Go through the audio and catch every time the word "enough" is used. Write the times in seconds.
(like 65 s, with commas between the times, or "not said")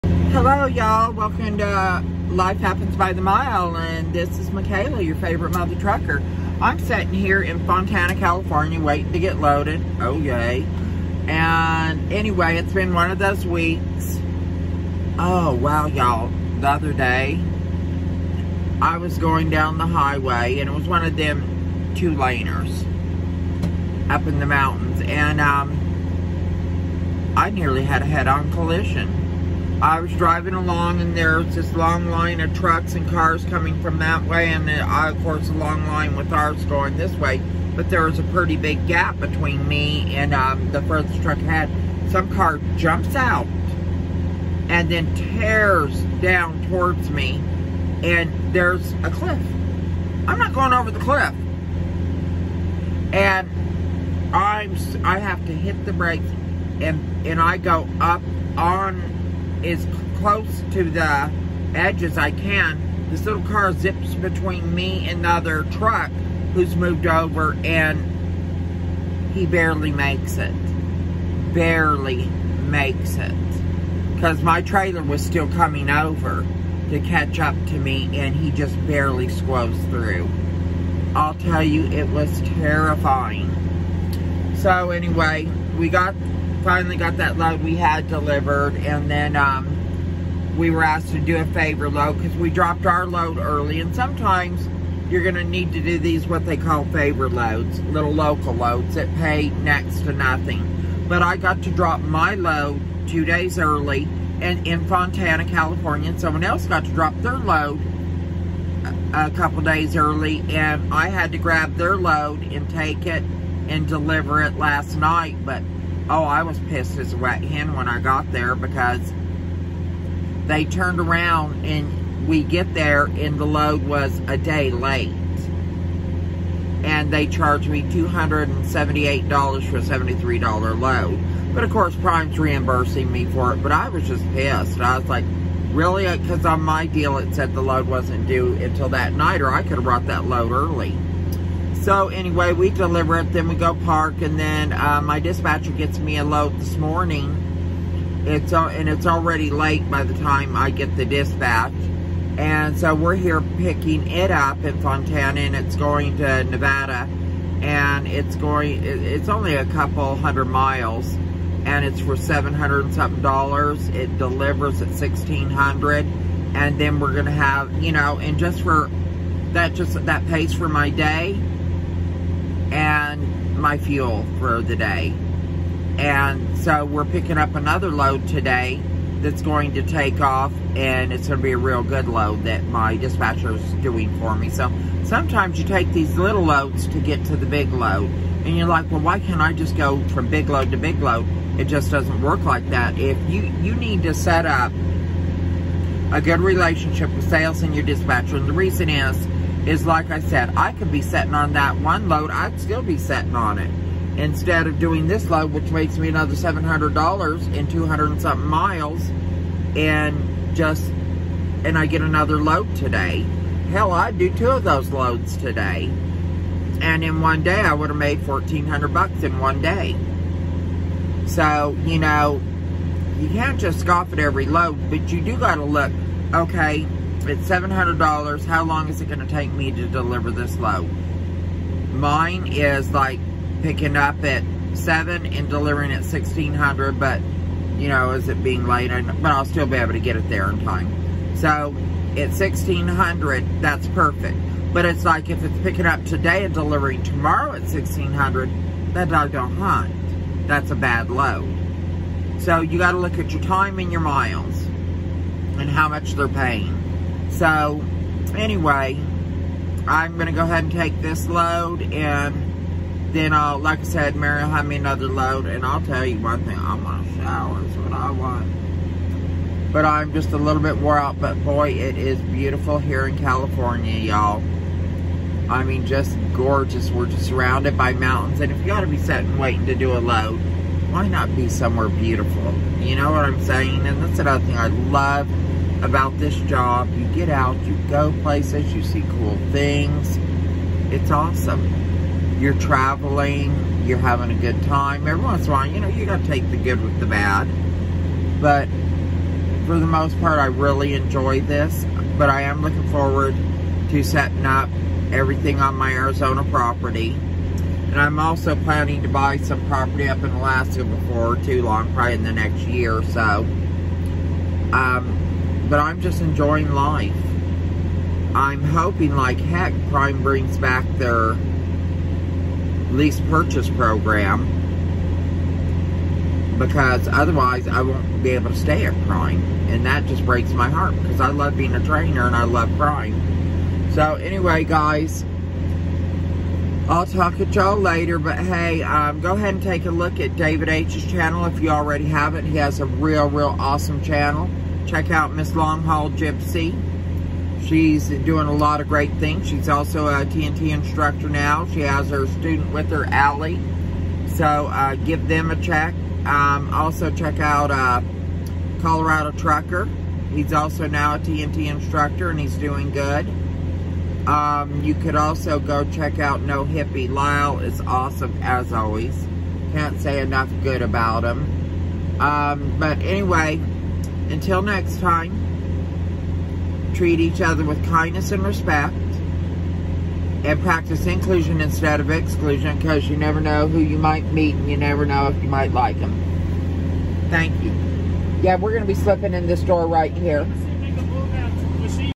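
370 s.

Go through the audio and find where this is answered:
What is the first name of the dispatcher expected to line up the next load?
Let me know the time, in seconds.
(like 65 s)
264 s.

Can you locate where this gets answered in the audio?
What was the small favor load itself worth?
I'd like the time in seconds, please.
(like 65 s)
129 s.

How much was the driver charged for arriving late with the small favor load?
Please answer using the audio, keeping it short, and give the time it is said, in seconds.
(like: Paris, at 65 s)
$278, at 127 s.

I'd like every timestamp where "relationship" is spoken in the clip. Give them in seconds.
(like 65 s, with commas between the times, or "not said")
196 s.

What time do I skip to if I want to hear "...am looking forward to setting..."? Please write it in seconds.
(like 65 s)
302 s.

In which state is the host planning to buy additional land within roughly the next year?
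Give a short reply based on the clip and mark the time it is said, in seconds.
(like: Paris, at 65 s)
Alaska, at 310 s.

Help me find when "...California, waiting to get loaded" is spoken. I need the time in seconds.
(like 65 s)
8 s.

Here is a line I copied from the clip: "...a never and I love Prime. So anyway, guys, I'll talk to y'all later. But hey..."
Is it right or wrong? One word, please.
wrong.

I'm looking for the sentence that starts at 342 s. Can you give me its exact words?
He has a real, real awesome channel check out Miss Long Haul Gypsy.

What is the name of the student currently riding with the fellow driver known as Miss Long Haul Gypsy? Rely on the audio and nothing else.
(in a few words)
Allie.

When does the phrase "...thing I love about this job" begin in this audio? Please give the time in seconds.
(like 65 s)
284 s.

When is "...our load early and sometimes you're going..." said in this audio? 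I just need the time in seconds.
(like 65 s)
92 s.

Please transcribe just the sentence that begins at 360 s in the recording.
He's also now a TNT instructor and he's doing good.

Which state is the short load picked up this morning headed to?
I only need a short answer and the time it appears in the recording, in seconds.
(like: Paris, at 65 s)
Nevada, at 156 s.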